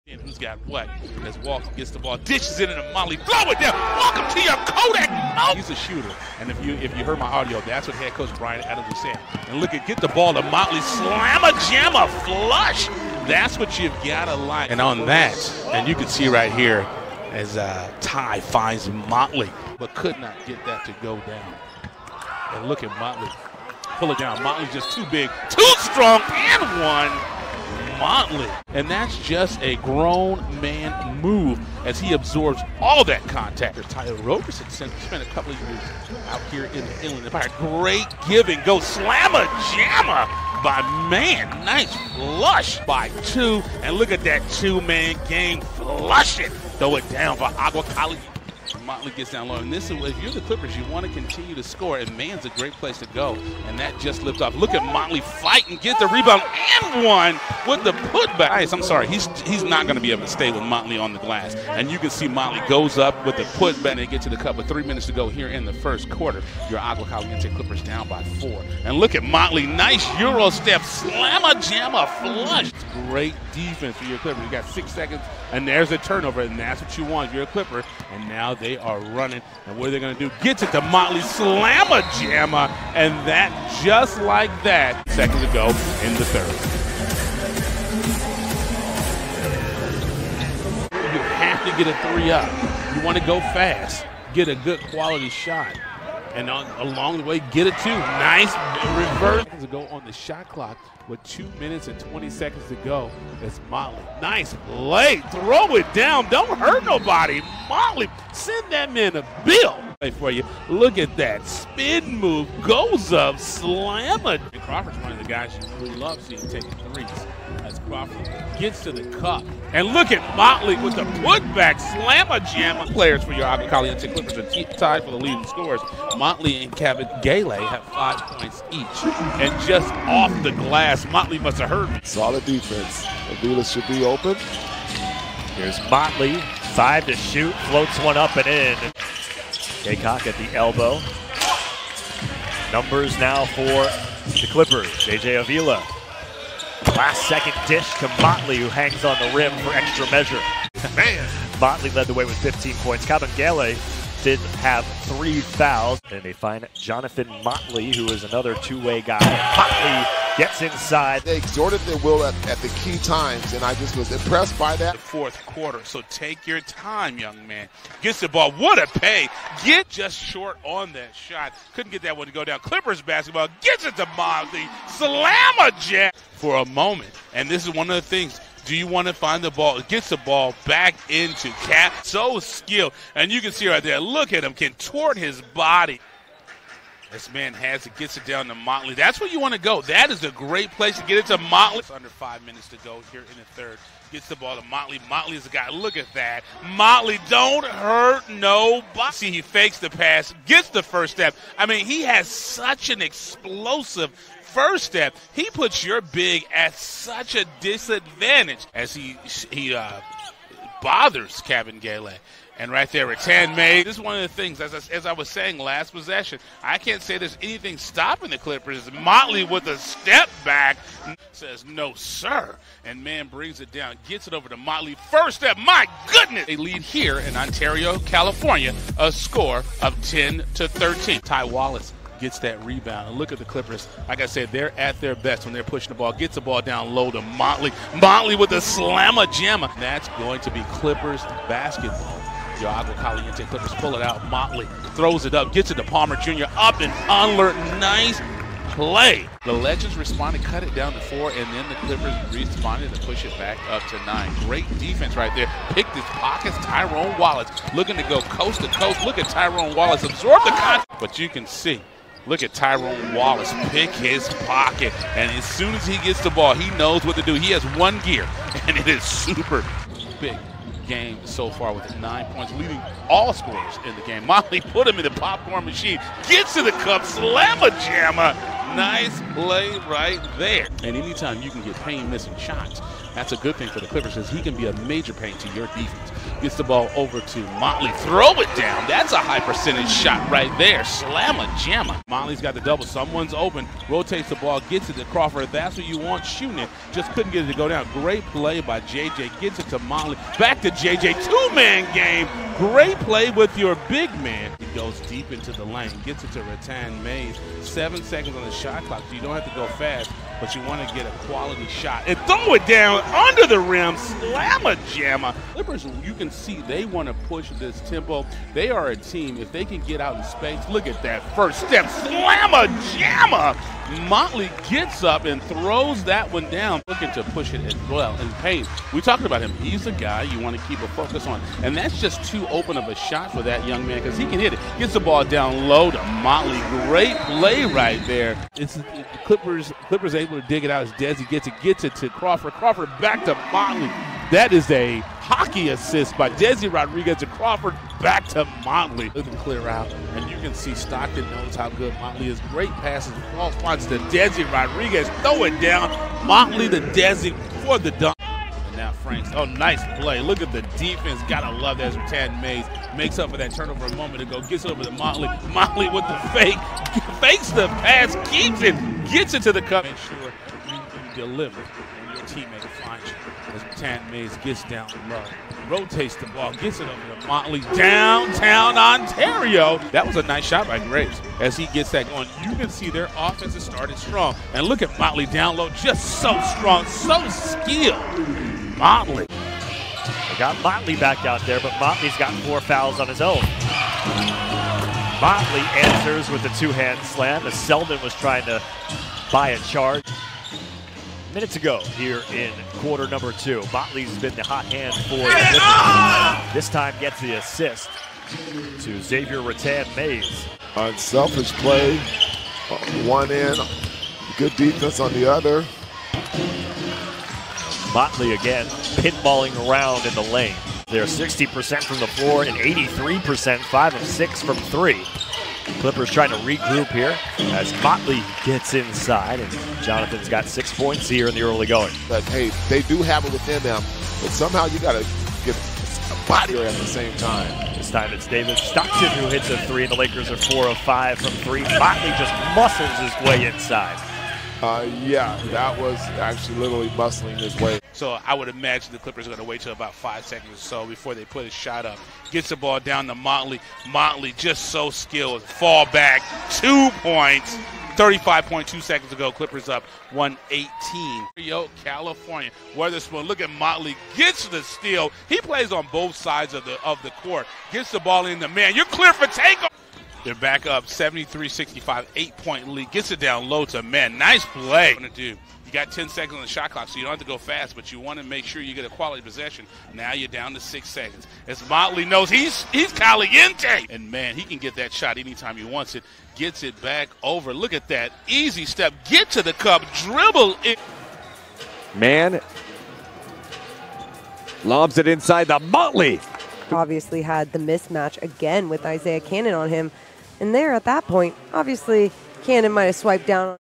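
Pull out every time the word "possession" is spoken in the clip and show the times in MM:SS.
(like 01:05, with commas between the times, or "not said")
03:35, 07:59.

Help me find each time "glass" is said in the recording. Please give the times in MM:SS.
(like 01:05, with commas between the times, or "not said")
01:01, 02:10.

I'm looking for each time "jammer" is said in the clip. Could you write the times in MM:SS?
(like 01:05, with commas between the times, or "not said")
00:38, 01:22, 03:59, 04:37, 04:51, 05:14, 05:22.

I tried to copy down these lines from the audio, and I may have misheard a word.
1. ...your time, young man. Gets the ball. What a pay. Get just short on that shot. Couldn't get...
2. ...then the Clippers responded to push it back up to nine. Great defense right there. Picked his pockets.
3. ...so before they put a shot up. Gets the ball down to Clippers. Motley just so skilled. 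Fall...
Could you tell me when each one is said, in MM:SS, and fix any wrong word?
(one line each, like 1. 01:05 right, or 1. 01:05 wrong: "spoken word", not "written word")
1. 02:46 right
2. 04:11 right
3. 07:30 wrong: "Motley", not "Clippers".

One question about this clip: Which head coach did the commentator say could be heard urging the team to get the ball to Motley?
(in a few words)
Brian Adams.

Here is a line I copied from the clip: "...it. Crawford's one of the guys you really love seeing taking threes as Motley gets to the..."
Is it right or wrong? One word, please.
wrong.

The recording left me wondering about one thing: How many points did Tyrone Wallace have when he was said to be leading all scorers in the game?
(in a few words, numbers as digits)
9.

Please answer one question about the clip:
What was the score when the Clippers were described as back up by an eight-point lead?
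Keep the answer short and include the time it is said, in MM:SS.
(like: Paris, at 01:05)
73-65, at 07:50.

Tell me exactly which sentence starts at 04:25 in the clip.
And as soon as he gets the ball, he knows what to do.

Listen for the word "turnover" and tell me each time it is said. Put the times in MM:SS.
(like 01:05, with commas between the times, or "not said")
01:15, 06:03.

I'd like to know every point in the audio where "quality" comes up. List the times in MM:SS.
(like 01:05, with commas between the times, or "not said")
01:34, 05:11, 07:58.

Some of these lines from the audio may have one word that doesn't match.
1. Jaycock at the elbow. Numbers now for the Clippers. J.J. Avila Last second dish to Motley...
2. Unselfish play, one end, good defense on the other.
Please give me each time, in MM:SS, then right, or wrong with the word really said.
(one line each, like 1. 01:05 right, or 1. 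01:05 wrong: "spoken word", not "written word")
1. 02:19 right
2. 06:50 right.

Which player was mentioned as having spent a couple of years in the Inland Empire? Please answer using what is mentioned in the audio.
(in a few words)
Tyler Roberson.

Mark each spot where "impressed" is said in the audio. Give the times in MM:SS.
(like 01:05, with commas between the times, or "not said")
02:44.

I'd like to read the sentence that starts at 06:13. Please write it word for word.
Rathan-Mayes gets down low, rotates the ball, gets it over to Motley, downtown Ontario.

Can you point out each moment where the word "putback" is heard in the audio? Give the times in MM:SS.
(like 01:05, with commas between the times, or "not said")
00:58, 01:03, 02:01.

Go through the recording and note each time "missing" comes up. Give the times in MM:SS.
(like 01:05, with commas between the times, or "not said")
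04:42.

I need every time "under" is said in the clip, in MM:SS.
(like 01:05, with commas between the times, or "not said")
03:11, 05:13.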